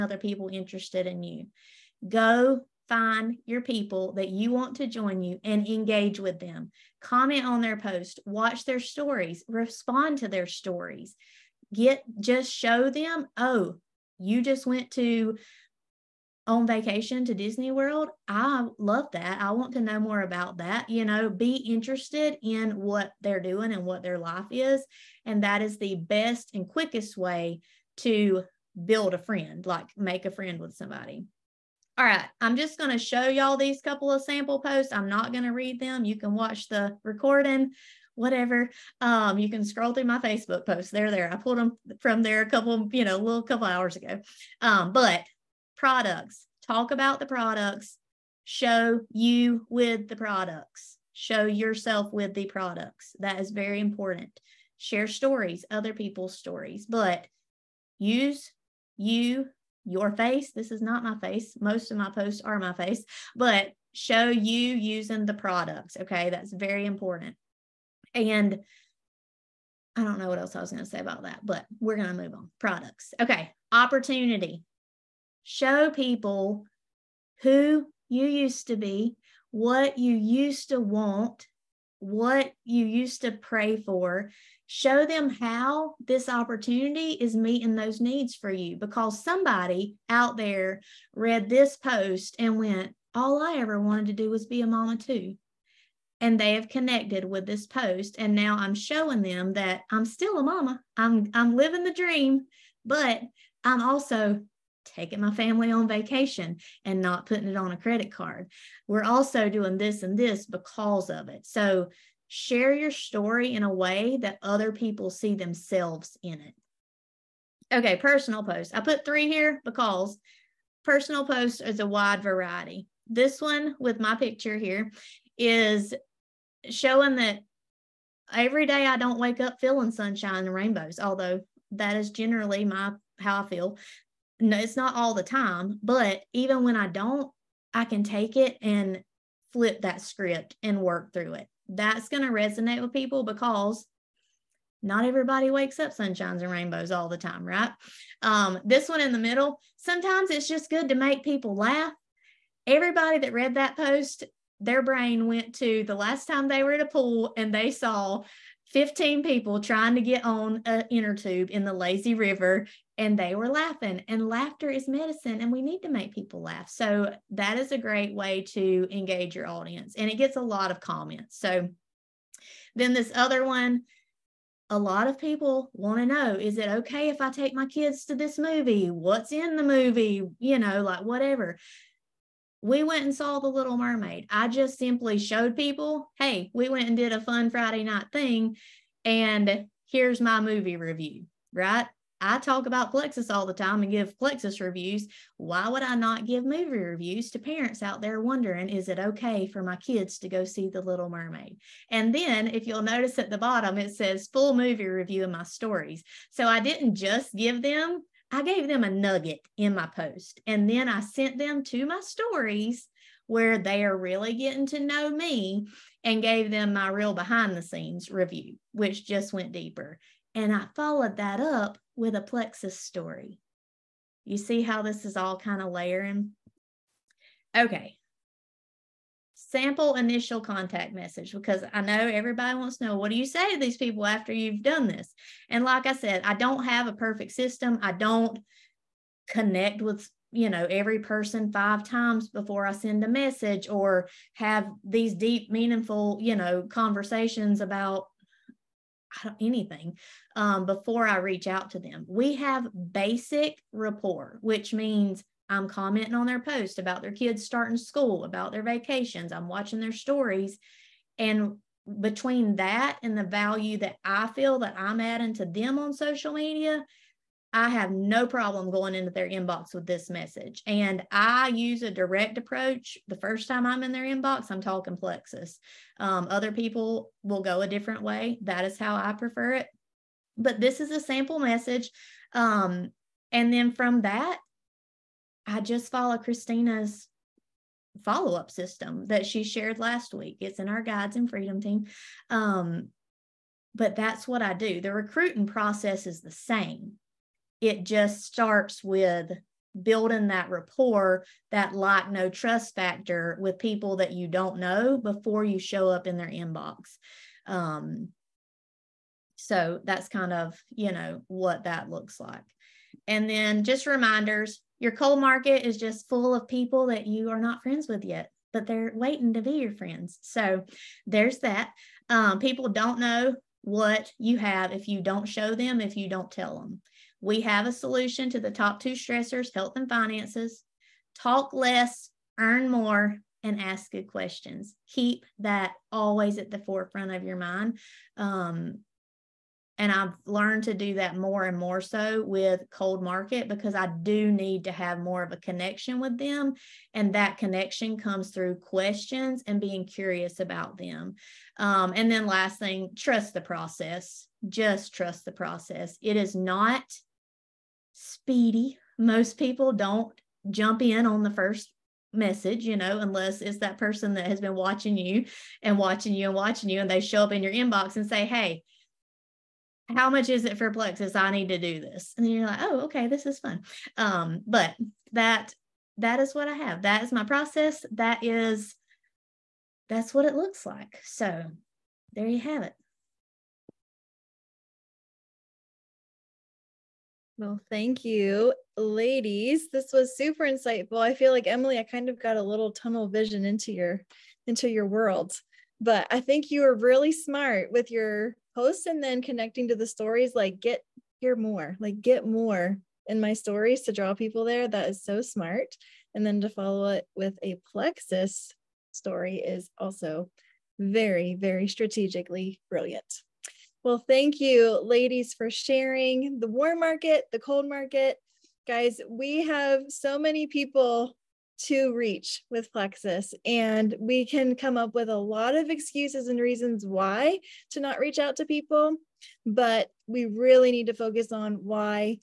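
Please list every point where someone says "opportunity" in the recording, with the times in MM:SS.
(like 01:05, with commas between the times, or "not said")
01:13, 01:26.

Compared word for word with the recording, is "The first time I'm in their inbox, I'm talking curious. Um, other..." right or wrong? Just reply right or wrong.
wrong.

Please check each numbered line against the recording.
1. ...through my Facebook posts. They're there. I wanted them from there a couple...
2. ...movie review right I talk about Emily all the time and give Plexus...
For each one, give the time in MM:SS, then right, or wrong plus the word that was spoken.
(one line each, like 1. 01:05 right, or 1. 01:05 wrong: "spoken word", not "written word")
1. 00:39 wrong: "pulled", not "wanted"
2. 03:10 wrong: "Plexus", not "Emily".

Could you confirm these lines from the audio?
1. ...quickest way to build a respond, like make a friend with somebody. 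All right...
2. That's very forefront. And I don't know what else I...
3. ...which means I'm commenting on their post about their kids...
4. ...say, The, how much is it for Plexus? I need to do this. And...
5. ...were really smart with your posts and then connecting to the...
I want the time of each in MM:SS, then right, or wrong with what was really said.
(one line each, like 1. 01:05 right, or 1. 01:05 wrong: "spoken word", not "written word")
1. 00:26 wrong: "friend", not "respond"
2. 01:06 wrong: "important", not "forefront"
3. 04:14 right
4. 06:08 wrong: "Hey", not "The"
5. 06:36 right.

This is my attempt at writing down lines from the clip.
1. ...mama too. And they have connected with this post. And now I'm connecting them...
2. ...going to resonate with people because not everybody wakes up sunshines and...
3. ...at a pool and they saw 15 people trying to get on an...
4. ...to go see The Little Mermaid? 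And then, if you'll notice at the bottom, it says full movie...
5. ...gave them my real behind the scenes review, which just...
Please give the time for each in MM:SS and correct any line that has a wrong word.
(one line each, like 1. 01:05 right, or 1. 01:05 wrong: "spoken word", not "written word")
1. 01:34 wrong: "showing", not "connecting"
2. 02:22 right
3. 02:36 right
4. 03:20 right
5. 03:36 right.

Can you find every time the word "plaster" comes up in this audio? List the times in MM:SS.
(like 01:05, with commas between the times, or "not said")
not said.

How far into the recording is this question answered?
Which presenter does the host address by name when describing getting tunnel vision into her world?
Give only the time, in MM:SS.
06:31.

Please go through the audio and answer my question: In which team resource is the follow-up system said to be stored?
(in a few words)
Guides and Freedom team.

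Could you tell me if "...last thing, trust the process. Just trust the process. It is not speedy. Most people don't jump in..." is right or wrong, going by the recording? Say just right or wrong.
right.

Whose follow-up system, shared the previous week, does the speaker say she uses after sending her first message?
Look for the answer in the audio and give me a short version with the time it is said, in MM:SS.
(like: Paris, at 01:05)
Christina, at 04:46.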